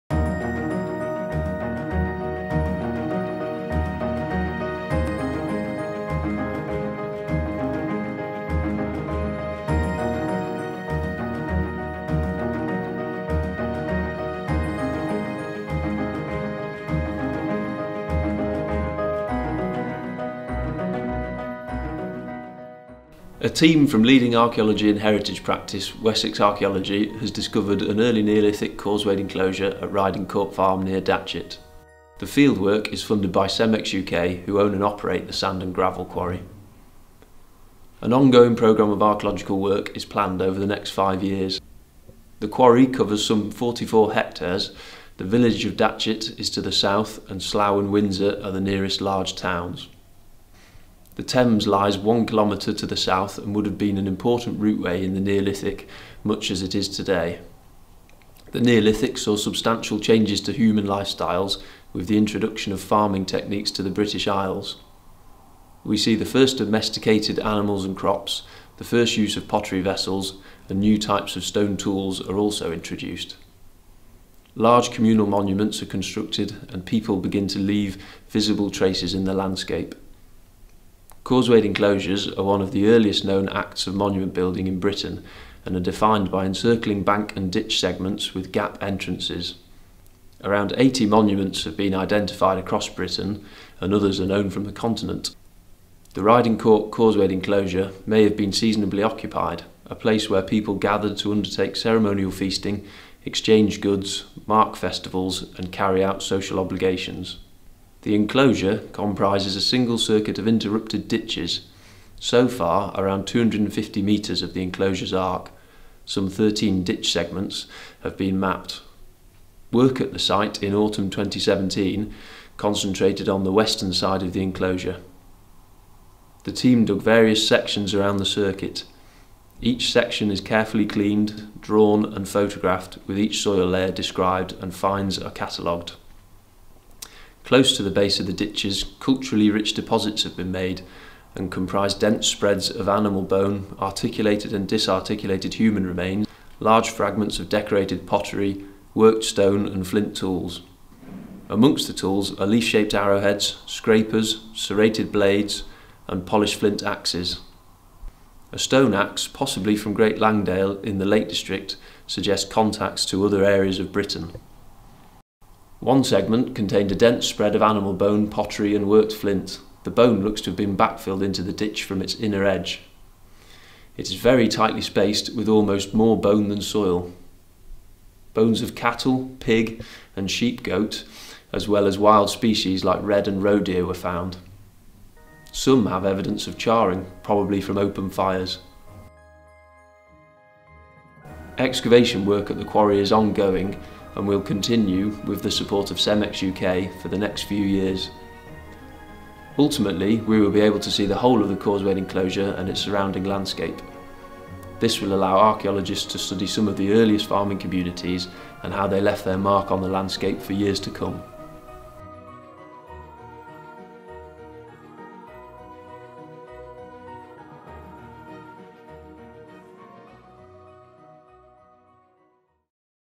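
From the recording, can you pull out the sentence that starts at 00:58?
The Neolithic saw substantial changes to human lifestyles with the introduction of farming techniques to the British Isles.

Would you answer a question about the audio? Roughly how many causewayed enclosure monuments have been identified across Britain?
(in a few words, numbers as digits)
80.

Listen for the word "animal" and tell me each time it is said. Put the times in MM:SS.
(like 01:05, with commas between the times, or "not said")
01:07, 02:22, 02:47.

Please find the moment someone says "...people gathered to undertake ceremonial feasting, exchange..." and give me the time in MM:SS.
01:40.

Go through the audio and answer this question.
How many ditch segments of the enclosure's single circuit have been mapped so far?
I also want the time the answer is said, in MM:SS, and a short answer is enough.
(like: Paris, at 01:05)
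13, at 01:56.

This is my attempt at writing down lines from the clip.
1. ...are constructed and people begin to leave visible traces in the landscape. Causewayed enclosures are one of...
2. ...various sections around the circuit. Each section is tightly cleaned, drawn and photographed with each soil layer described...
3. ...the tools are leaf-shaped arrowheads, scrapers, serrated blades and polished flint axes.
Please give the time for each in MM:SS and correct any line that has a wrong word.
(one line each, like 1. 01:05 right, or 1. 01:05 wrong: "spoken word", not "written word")
1. 01:15 right
2. 02:07 wrong: "carefully", not "tightly"
3. 02:31 right.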